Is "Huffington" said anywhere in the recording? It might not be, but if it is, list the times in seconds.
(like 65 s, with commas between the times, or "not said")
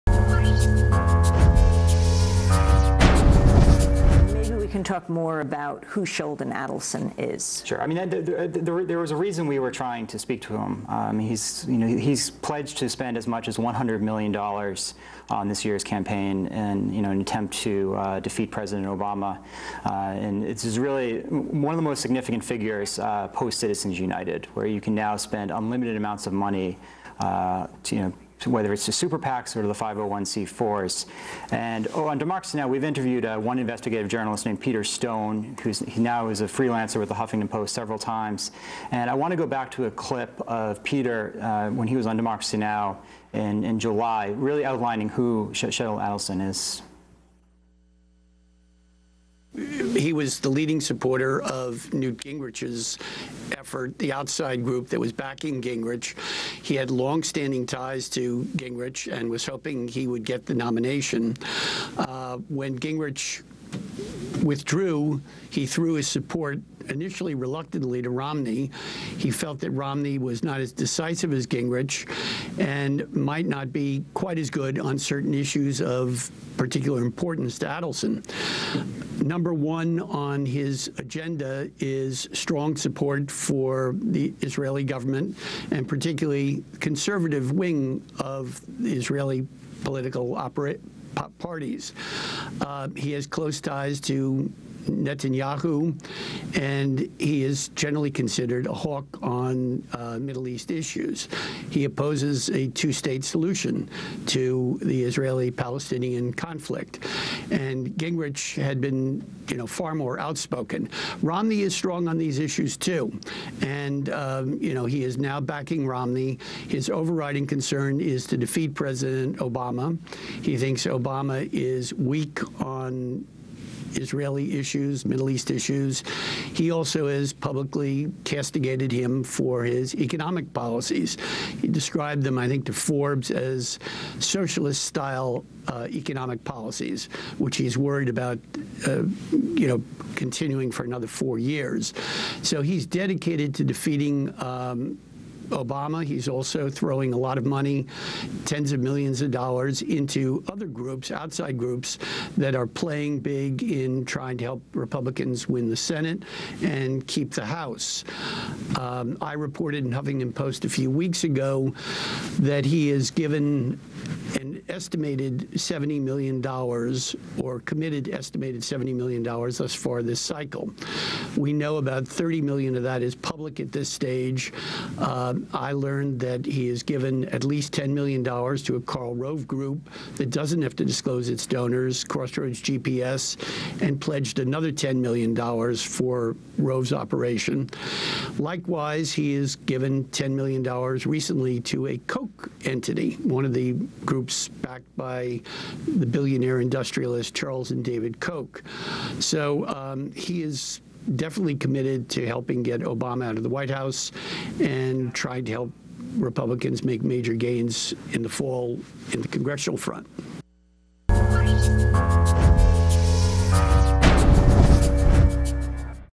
37 s, 159 s.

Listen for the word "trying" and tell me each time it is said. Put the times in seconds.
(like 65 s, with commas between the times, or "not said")
9 s, 154 s, 205 s.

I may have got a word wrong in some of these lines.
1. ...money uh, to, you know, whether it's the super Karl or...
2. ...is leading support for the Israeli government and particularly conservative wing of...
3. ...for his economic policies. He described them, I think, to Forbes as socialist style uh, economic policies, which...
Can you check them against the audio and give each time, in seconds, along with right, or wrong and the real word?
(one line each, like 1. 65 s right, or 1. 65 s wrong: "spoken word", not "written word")
1. 26 s wrong: "PACs", not "Karl"
2. 81 s wrong: "strong", not "leading"
3. 129 s right.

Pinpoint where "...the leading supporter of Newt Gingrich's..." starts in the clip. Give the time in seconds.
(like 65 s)
50 s.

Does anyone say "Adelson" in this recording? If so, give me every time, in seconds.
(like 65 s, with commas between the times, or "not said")
6 s, 46 s, 77 s.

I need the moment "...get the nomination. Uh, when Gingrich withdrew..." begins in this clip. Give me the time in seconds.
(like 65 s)
60 s.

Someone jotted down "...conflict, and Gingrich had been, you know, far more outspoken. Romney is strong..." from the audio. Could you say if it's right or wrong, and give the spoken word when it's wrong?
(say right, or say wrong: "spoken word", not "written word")
right.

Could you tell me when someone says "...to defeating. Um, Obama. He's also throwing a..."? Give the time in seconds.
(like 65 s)
143 s.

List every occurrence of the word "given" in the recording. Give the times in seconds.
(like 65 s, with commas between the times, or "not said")
163 s, 176 s, 189 s.